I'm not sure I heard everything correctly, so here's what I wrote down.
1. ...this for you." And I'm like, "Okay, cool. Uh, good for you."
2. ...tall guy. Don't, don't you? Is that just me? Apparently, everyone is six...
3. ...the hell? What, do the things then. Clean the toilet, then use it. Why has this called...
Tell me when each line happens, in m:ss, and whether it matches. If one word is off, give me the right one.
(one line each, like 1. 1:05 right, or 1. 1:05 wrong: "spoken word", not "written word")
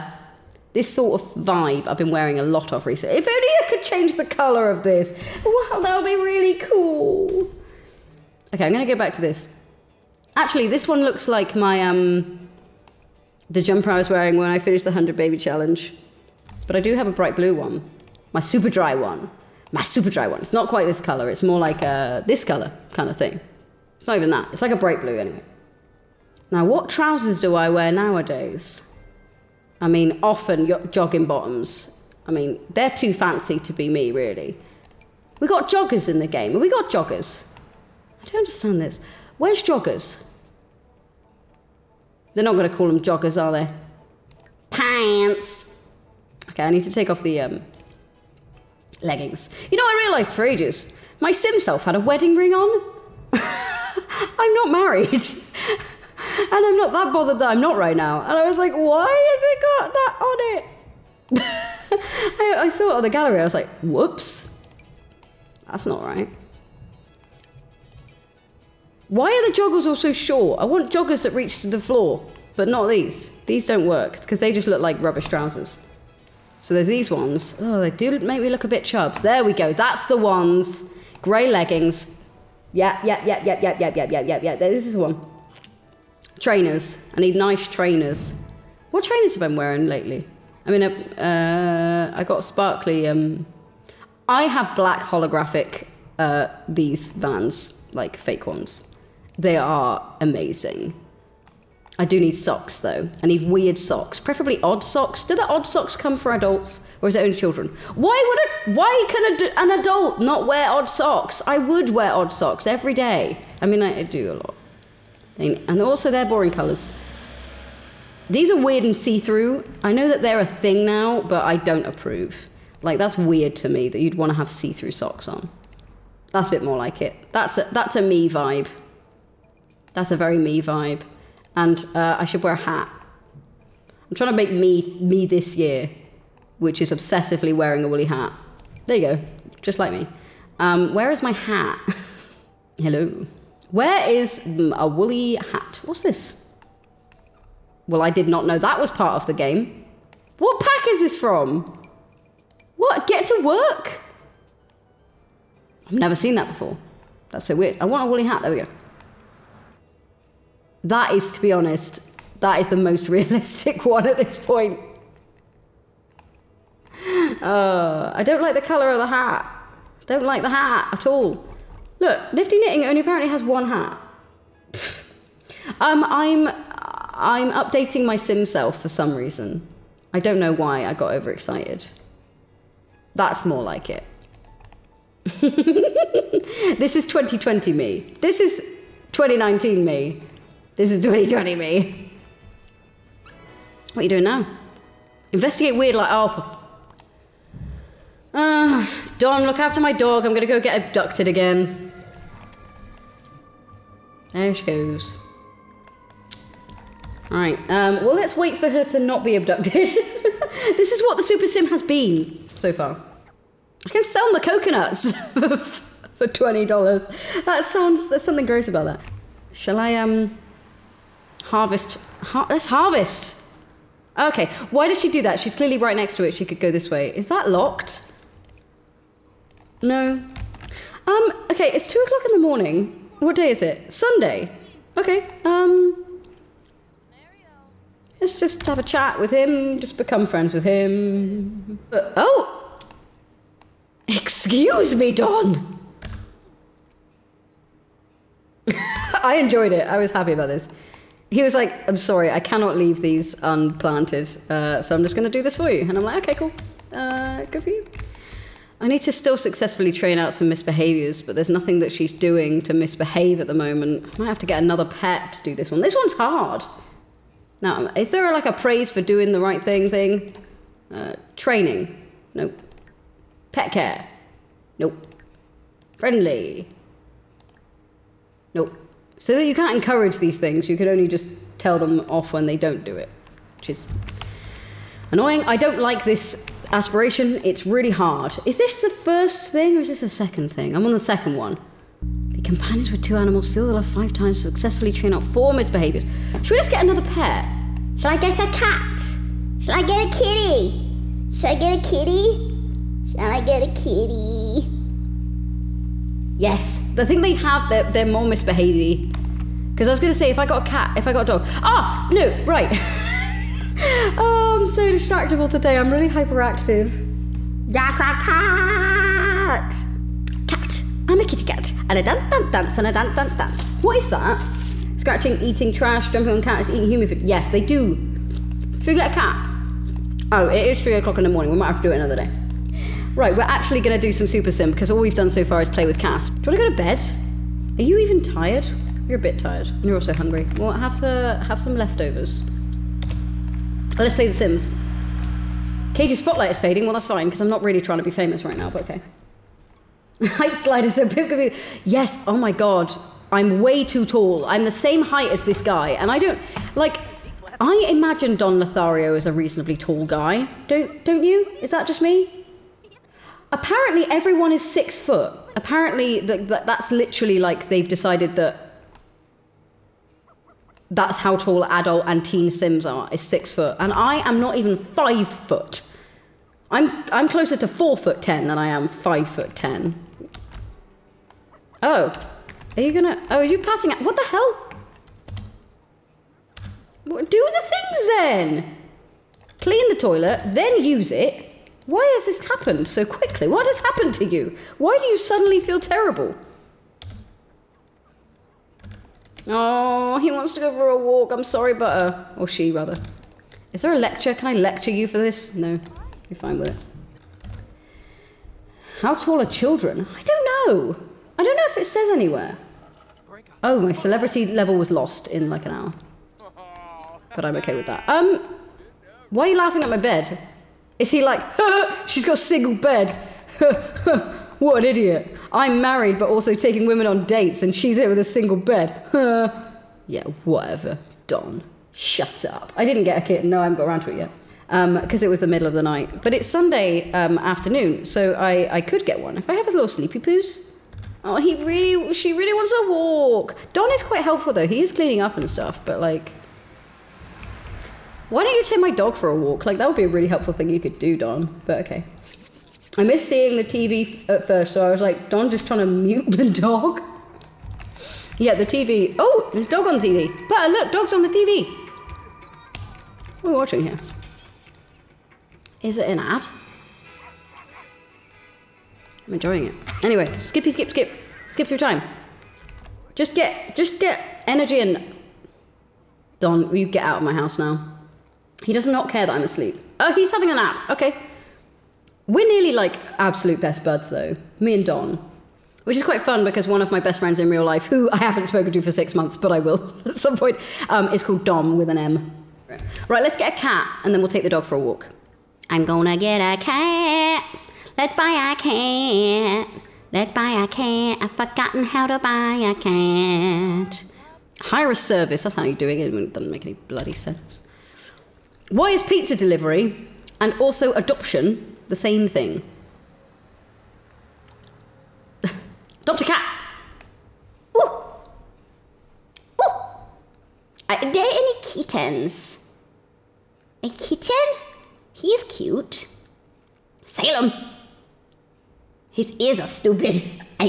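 1. 4:15 right
2. 5:59 right
3. 6:24 wrong: "happened", not "called".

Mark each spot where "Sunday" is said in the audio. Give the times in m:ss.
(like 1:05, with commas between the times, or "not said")
3:53, 7:16.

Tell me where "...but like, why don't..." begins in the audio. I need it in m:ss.
7:25.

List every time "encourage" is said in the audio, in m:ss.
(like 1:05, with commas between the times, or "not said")
4:39.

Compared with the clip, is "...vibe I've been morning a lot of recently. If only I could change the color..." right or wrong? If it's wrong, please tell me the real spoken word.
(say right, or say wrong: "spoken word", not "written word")
wrong: "wearing", not "morning".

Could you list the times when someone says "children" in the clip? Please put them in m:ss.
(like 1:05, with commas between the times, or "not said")
1:47, 6:49.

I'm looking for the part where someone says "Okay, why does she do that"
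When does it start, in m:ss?
3:44.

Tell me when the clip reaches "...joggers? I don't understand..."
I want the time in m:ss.
0:36.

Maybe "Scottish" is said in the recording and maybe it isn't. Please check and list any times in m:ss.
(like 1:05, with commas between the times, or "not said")
not said.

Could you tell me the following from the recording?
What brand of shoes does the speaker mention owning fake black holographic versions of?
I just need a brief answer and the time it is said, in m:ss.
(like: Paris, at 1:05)
Vans, at 1:36.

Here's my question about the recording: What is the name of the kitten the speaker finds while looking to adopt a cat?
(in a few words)
Salem.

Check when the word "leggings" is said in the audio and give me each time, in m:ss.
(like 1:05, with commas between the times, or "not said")
0:49, 1:21.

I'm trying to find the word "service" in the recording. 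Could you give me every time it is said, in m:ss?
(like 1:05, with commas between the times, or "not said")
8:24.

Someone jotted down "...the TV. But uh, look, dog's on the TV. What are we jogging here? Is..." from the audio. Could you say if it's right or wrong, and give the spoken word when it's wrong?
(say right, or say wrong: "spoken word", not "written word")
wrong: "watching", not "jogging".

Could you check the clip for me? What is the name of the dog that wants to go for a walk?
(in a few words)
Butter.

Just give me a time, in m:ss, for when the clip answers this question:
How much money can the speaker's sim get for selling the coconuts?
3:36.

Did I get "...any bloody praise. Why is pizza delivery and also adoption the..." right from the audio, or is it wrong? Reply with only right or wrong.
wrong.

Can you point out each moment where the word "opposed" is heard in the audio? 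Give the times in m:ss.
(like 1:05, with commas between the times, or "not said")
not said.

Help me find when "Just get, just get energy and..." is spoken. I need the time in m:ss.
7:53.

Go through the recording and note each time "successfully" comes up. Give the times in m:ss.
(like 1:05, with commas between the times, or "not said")
4:19, 4:54.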